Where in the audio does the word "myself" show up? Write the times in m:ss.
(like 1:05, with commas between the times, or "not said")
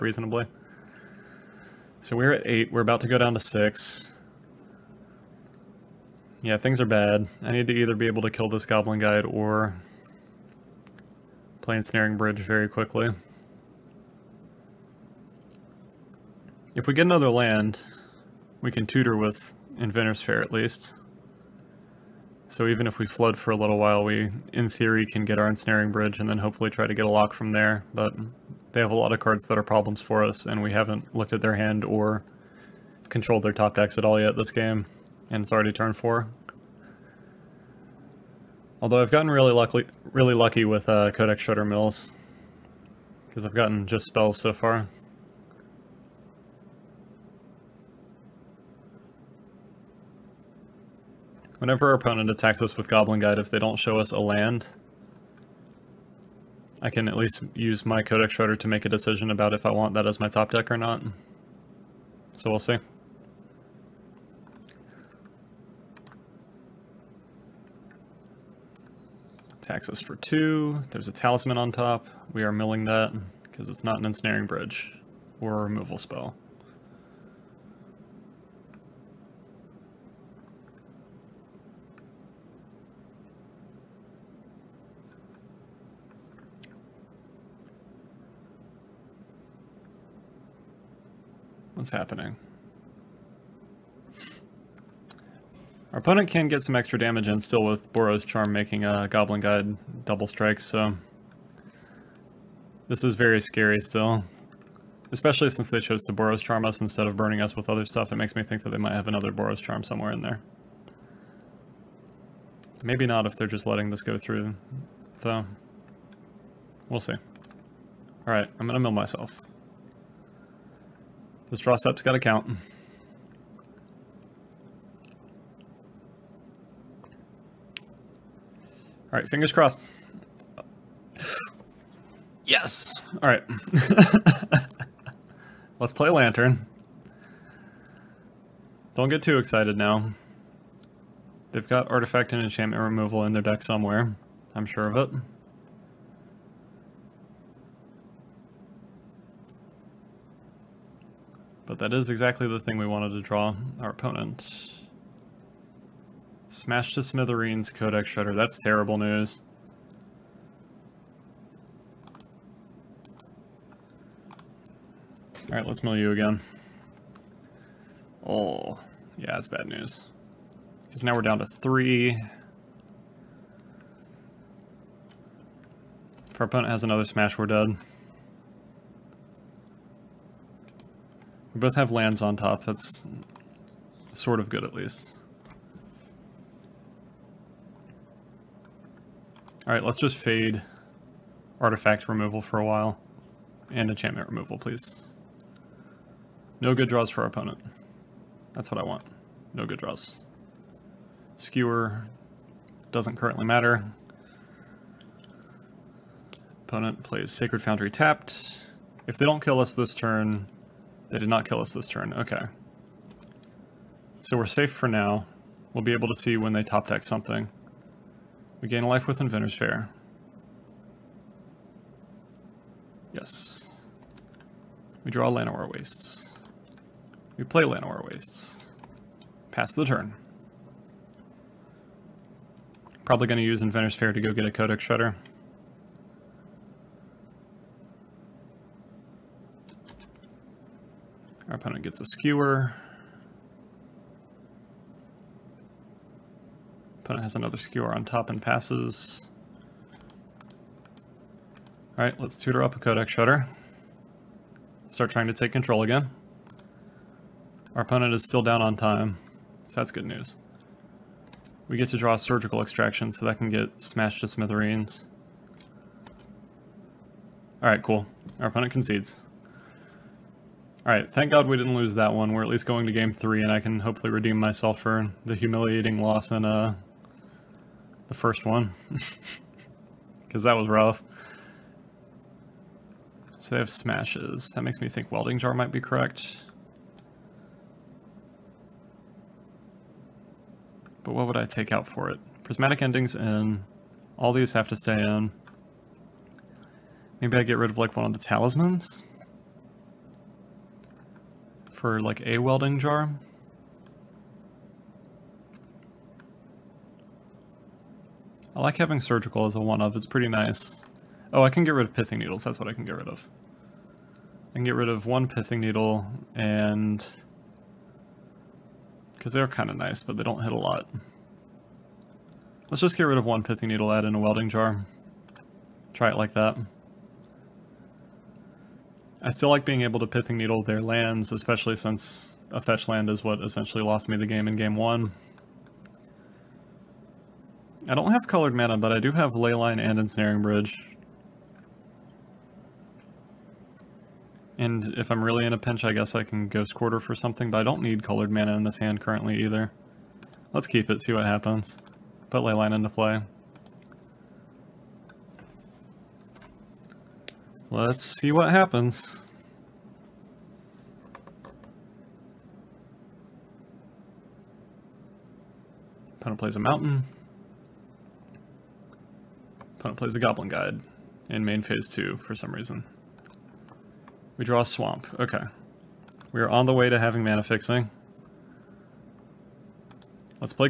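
1:58, 4:34.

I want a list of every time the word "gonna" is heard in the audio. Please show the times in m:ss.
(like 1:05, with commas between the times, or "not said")
1:58.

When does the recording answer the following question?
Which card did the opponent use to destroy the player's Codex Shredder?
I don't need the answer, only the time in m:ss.
2:36.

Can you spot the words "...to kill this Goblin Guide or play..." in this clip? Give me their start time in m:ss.
0:08.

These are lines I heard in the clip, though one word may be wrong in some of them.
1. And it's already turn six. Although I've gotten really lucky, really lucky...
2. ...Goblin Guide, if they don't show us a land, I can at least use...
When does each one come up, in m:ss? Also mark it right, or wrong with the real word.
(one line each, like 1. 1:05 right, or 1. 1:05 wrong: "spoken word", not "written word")
1. 0:35 wrong: "four", not "six"
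2. 0:52 right.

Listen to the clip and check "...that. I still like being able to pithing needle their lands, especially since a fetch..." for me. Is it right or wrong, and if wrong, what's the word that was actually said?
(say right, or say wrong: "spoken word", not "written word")
right.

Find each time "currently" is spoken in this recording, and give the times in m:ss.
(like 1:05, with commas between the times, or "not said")
3:23, 5:48.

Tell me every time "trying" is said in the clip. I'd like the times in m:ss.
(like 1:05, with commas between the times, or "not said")
4:15.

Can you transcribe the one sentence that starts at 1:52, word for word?
Maybe not if they're just letting this go through, though.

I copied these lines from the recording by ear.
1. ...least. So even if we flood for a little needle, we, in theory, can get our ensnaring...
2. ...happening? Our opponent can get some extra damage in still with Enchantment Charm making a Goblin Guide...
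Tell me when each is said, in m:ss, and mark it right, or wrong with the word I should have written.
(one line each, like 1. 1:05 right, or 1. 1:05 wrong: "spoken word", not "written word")
1. 0:20 wrong: "while", not "needle"
2. 1:31 wrong: "Boros", not "Enchantment".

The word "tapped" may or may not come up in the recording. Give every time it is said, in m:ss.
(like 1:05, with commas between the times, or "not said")
3:27.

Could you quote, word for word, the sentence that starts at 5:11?
Oh, I can get rid of pithing needles, that's what I can get rid of.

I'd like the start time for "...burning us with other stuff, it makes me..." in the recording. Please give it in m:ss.
1:47.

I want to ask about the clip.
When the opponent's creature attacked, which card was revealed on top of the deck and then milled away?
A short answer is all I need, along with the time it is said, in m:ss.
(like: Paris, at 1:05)
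Talisman, at 1:11.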